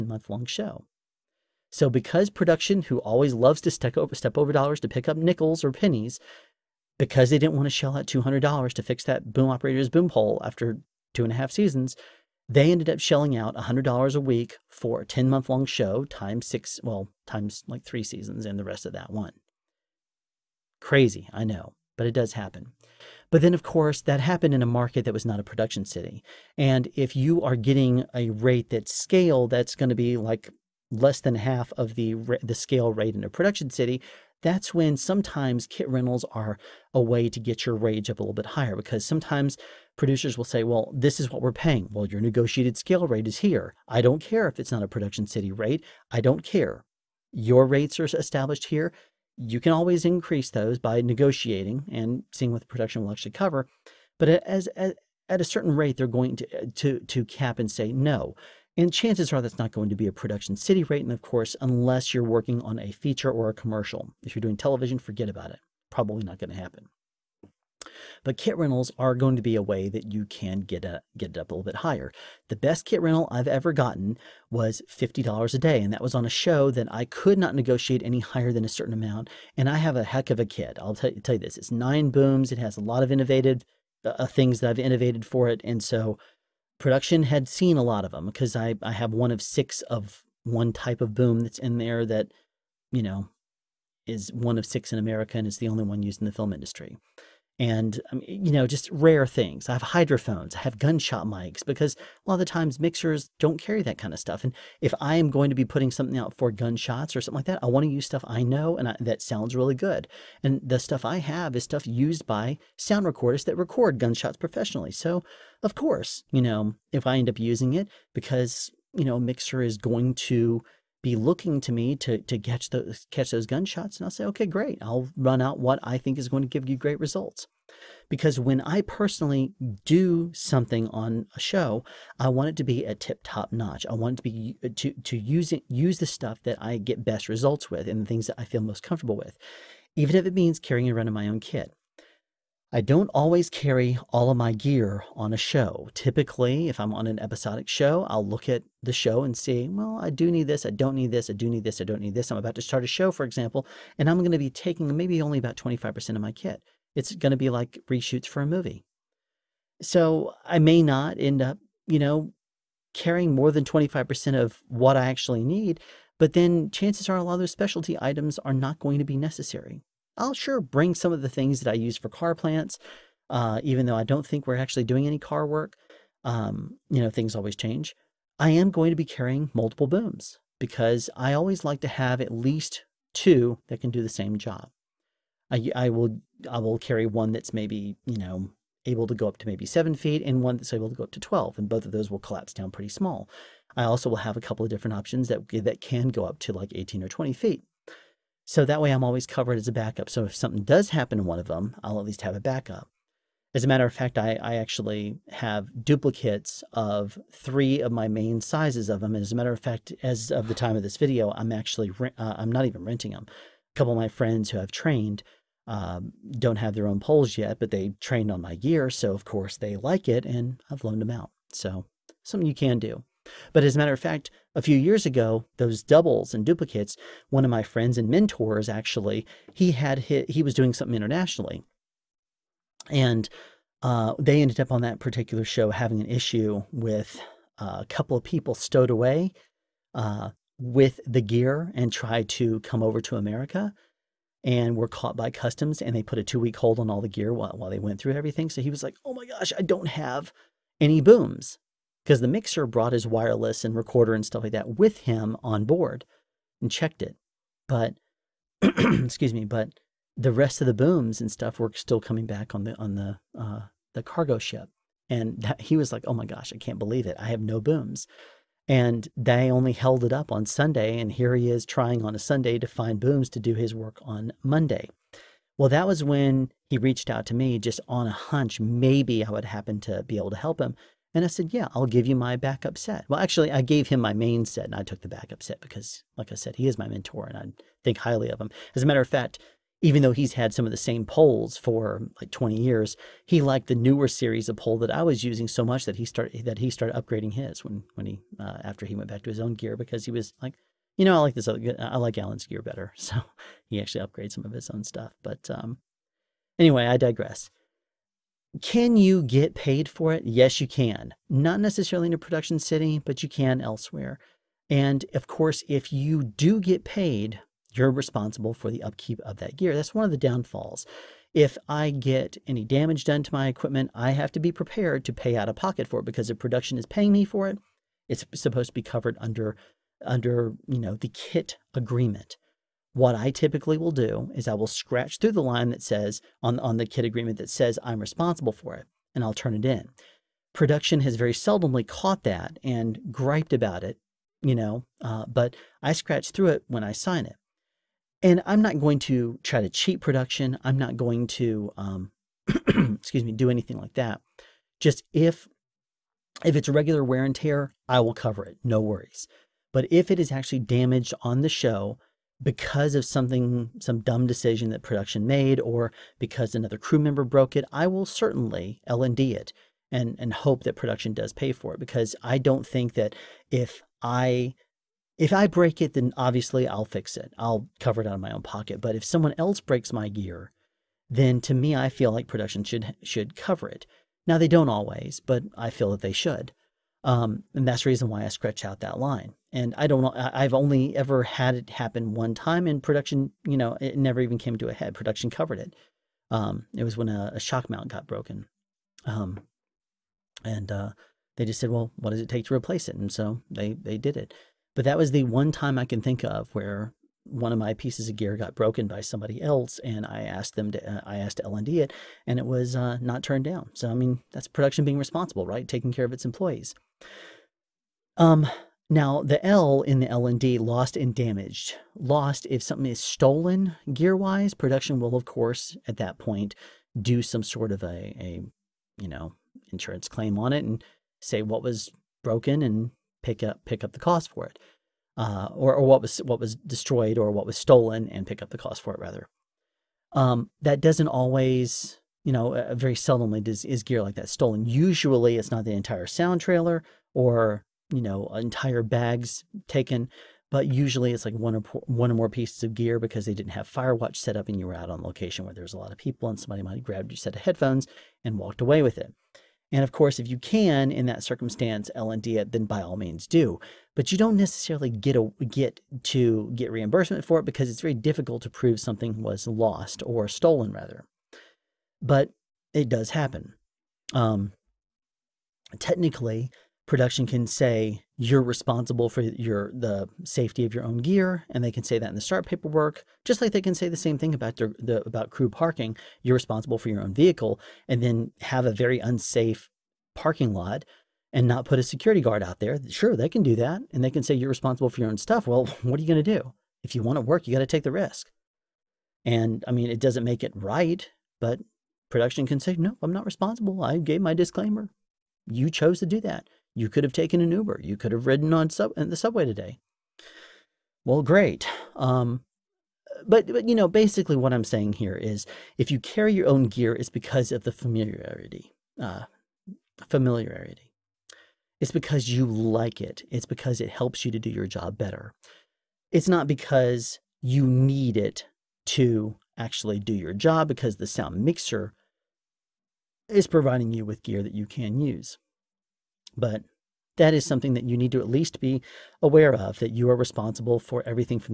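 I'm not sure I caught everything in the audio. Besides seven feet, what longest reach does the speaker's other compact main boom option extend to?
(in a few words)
12 feet.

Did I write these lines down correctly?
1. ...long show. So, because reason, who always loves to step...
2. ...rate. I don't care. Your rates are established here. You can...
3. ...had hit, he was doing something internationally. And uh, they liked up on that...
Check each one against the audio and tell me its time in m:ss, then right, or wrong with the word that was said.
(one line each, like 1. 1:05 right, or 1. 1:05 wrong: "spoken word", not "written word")
1. 0:00 wrong: "production", not "reason"
2. 0:45 right
3. 3:49 wrong: "ended", not "liked".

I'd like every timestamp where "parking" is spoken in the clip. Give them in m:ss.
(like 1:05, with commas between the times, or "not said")
8:05, 8:10.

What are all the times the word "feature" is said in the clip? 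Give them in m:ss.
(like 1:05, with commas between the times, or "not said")
1:02.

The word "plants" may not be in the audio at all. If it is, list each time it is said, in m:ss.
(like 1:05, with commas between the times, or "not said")
2:52.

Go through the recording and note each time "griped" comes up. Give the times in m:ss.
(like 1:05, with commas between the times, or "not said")
5:43.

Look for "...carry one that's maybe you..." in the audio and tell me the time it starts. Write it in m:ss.
3:06.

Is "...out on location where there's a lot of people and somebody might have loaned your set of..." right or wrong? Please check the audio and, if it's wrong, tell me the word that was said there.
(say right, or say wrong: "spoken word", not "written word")
wrong: "grabbed", not "loaned".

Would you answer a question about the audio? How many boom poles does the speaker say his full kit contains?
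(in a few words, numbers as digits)
9.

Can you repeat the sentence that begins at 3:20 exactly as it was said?
So if something does happen to one of them, I'll at least have a backup.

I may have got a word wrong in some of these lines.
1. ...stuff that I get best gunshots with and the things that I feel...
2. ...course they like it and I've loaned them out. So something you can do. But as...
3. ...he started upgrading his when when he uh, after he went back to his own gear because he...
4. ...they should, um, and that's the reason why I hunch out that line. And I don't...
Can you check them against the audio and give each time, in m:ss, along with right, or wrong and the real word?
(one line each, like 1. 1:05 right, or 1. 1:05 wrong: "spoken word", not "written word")
1. 2:16 wrong: "results", not "gunshots"
2. 3:39 right
3. 4:56 right
4. 6:26 wrong: "scratch", not "hunch".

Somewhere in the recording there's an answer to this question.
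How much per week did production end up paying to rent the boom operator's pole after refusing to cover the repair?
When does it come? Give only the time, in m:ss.
0:13.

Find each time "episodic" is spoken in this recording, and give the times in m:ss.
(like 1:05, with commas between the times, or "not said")
2:27.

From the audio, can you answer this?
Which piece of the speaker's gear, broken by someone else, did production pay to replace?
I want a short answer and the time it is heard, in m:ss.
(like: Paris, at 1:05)
shock mount, at 6:37.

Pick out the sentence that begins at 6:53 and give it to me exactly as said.
So, I mean, that's production being responsible, right?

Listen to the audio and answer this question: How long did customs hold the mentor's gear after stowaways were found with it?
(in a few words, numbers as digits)
2 weeks.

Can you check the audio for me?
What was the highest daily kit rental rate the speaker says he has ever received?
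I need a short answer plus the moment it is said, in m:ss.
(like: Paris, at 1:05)
$50 a day, at 1:14.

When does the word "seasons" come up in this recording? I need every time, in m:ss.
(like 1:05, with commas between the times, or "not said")
0:11, 0:18.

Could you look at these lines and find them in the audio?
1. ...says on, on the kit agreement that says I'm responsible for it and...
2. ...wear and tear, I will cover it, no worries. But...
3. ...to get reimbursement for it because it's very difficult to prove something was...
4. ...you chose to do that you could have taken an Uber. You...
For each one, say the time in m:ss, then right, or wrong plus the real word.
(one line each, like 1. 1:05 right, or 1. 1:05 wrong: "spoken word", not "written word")
1. 5:35 right
2. 5:57 right
3. 7:46 right
4. 8:25 right.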